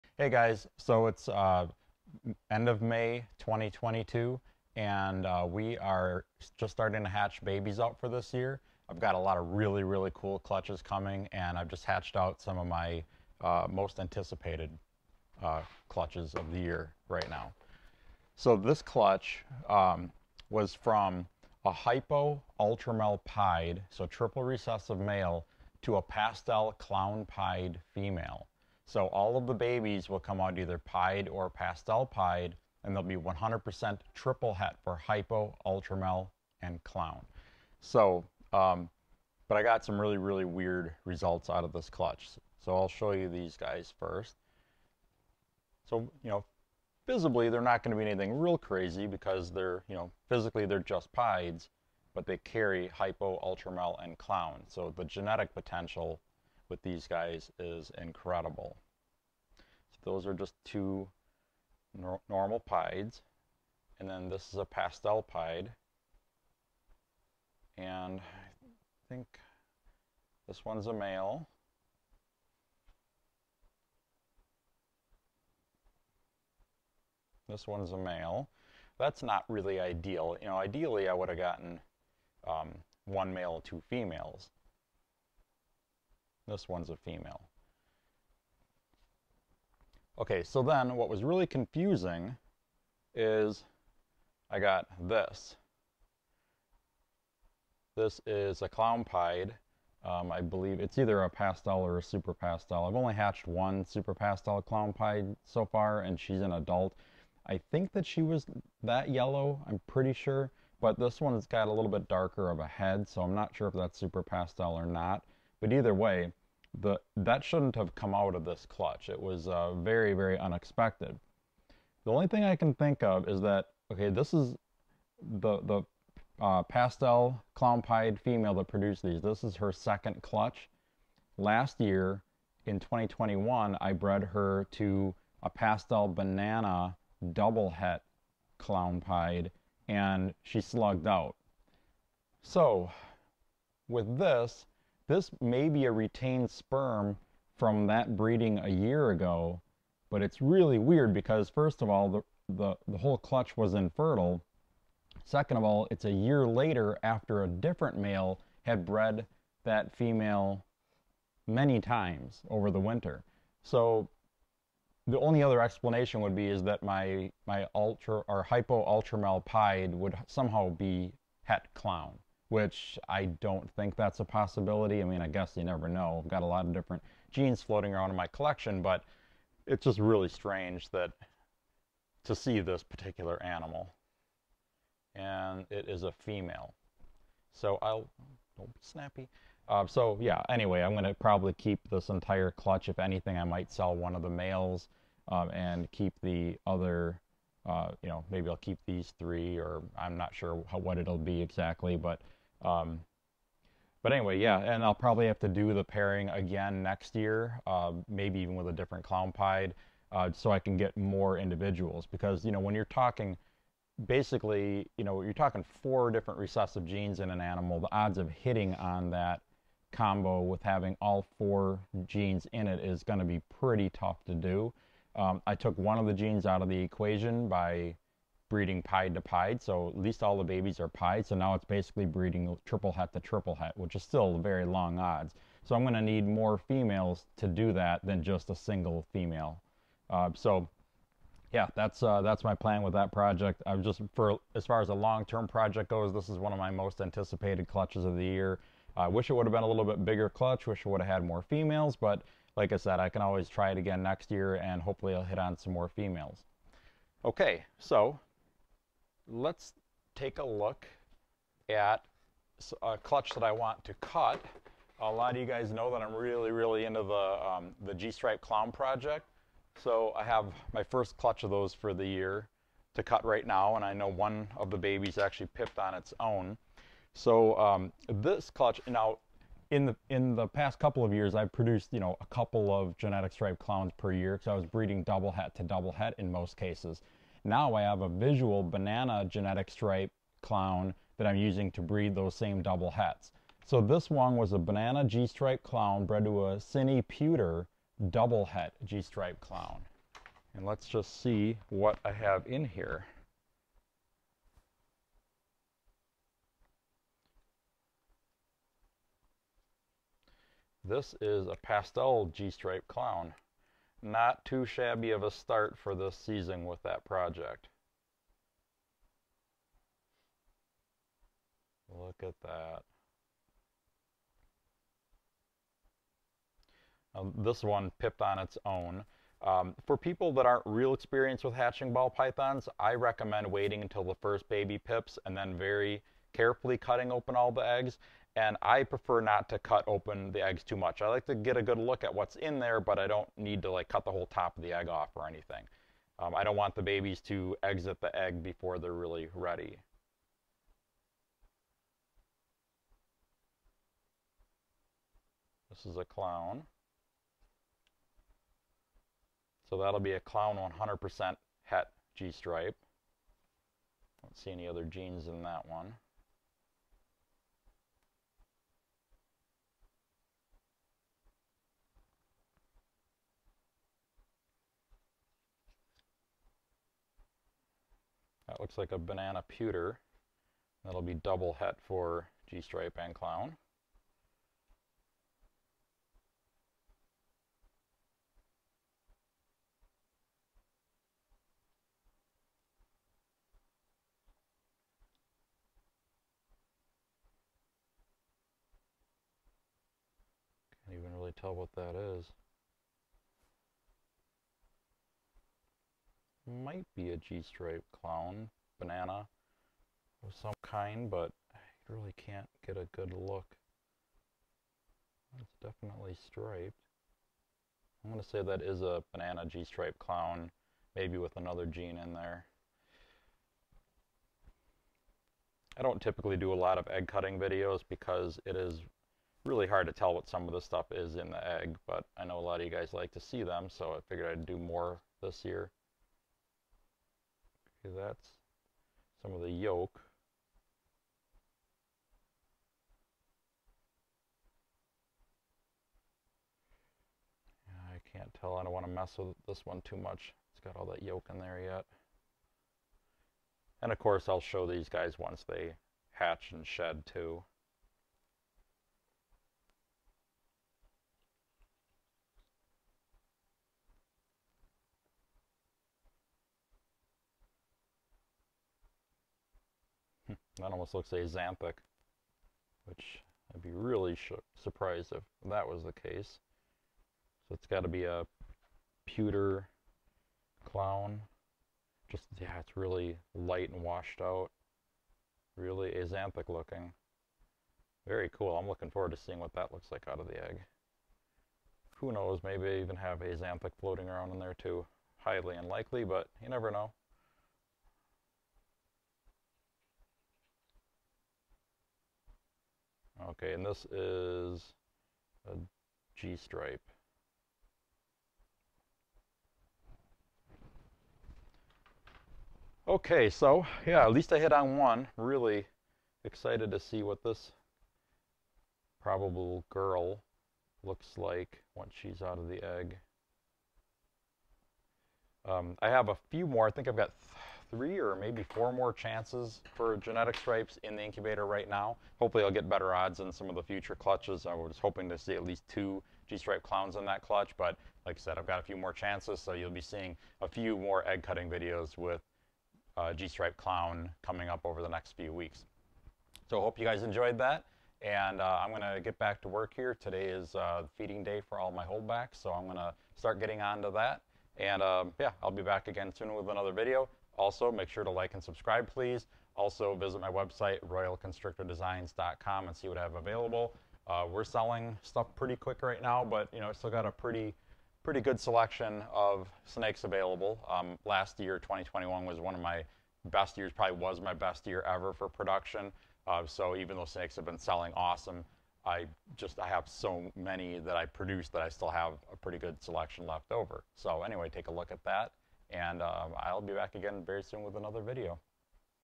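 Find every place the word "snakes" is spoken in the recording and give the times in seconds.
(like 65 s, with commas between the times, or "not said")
569 s, 577 s.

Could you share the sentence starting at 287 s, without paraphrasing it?
Now I have a visual banana genetic stripe clown that I'm using to breed those same double hets.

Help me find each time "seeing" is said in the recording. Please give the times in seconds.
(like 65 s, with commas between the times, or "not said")
489 s, 539 s.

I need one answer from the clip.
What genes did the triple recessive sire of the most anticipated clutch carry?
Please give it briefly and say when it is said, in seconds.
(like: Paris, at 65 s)
Hypo ultramel pied, at 21 s.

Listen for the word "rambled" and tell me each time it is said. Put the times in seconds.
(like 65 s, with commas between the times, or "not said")
not said.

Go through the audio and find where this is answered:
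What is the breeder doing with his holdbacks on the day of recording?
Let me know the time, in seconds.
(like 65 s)
550 s.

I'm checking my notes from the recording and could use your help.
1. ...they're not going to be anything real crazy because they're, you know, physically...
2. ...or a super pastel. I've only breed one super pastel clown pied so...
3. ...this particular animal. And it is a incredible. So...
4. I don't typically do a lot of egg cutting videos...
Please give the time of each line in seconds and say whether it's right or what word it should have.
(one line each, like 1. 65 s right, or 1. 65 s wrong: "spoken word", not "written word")
1. 47 s right
2. 101 s wrong: "hatched", not "breed"
3. 182 s wrong: "female", not "incredible"
4. 425 s right.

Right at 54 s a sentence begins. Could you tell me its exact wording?
So the genetic potential with these guys is incredible.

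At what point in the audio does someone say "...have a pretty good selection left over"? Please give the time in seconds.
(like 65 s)
581 s.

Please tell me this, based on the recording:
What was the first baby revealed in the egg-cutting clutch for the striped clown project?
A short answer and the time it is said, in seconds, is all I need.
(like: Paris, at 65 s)
Pastel G-stripe clown, at 311 s.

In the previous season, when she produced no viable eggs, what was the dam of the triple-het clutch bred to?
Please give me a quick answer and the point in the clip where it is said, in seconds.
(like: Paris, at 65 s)
Pastel banana double het clown pied, at 135 s.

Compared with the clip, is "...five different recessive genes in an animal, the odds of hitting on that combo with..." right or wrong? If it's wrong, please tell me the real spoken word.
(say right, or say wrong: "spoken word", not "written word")
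wrong: "four", not "five".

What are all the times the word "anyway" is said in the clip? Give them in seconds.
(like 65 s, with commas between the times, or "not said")
190 s, 204 s, 584 s.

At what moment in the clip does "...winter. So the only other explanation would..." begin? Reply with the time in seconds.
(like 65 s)
162 s.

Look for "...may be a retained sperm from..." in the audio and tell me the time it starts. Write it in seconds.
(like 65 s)
145 s.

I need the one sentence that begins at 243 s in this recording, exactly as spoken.
I'm just for as far as a long-term project goes, this is one of my most anticipated clutches of the year.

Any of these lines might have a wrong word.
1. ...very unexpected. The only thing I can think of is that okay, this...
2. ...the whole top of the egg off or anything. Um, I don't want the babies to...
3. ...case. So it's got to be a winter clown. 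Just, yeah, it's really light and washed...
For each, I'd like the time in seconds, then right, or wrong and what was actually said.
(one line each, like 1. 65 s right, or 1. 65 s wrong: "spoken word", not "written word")
1. 120 s right
2. 344 s right
3. 476 s wrong: "pewter", not "winter".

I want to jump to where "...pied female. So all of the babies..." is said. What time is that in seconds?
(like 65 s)
27 s.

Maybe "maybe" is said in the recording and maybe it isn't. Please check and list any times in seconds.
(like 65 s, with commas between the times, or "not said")
198 s, 208 s, 420 s, 492 s, 528 s.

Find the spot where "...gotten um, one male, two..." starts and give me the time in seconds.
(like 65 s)
81 s.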